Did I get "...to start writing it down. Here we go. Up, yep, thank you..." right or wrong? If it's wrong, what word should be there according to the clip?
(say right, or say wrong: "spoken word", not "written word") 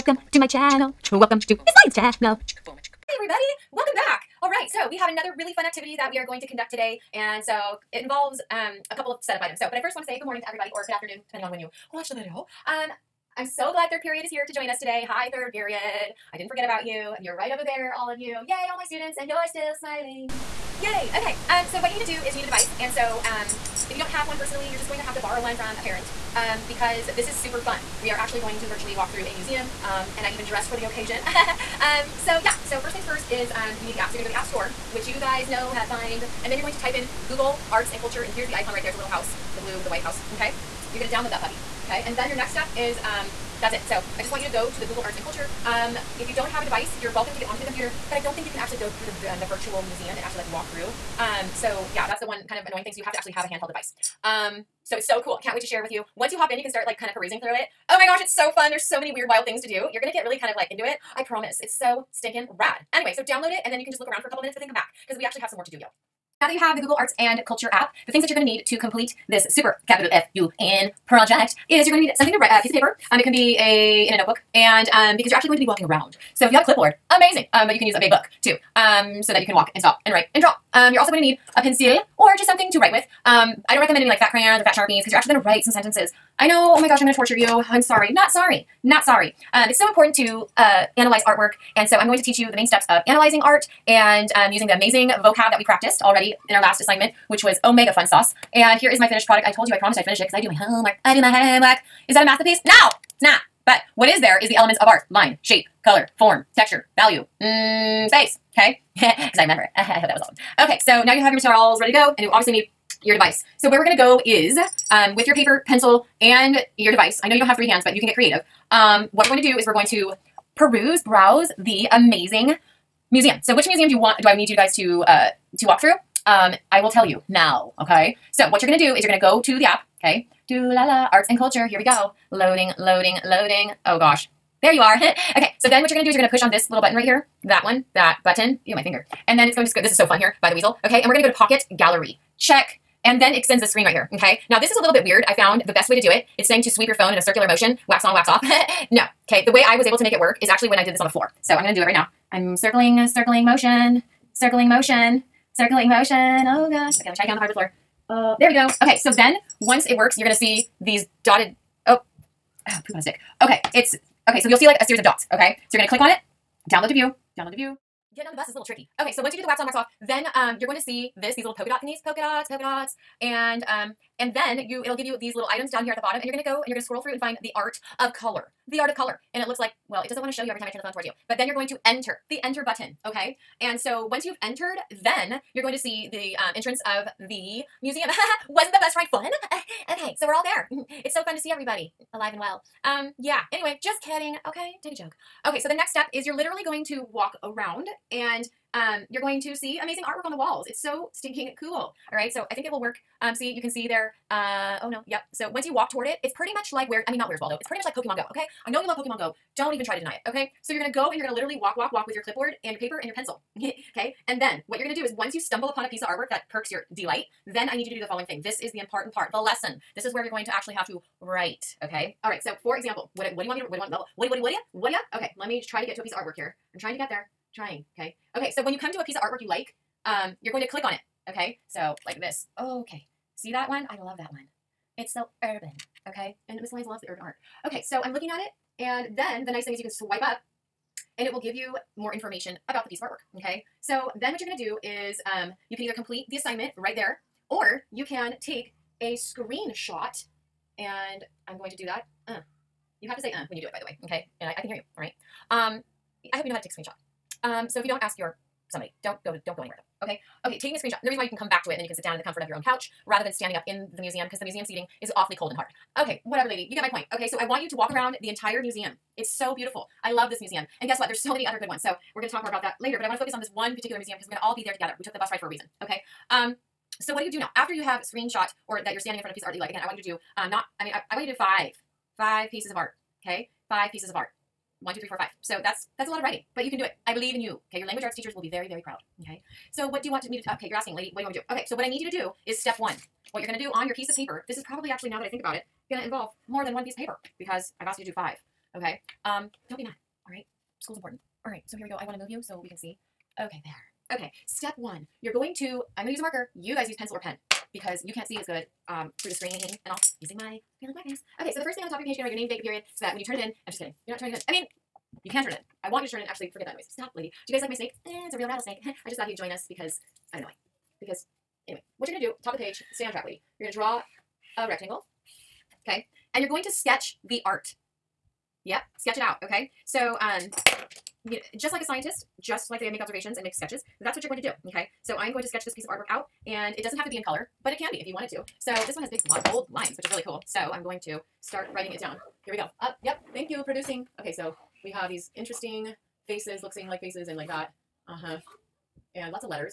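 right.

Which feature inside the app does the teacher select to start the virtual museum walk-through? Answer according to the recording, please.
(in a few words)
Pocket Gallery.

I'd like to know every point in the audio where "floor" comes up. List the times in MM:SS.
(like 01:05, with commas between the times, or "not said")
02:31, 02:37.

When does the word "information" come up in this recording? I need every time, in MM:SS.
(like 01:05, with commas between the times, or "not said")
04:02.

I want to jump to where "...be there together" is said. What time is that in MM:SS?
04:34.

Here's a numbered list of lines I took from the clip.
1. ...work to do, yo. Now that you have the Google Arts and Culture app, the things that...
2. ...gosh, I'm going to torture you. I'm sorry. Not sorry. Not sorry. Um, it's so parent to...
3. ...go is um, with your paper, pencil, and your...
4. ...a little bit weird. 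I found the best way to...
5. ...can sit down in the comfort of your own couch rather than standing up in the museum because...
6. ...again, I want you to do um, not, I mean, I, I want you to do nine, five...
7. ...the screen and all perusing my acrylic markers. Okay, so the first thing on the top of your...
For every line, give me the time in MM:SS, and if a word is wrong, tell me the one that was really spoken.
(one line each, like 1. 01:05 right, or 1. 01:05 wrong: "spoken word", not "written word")
1. 01:05 right
2. 01:26 wrong: "important", not "parent"
3. 01:53 right
4. 02:24 right
5. 04:21 right
6. 04:39 wrong: "five", not "nine"
7. 05:09 wrong: "using", not "perusing".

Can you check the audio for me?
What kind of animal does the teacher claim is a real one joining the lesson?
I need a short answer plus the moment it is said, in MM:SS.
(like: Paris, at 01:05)
rattlesnake, at 05:18.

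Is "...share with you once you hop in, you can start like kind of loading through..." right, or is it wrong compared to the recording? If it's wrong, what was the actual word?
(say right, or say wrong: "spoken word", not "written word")
wrong: "perusing", not "loading".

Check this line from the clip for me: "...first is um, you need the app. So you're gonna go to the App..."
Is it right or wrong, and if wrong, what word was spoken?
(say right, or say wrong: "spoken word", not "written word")
right.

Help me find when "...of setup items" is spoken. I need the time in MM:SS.
00:09.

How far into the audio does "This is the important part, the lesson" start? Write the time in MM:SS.
03:38.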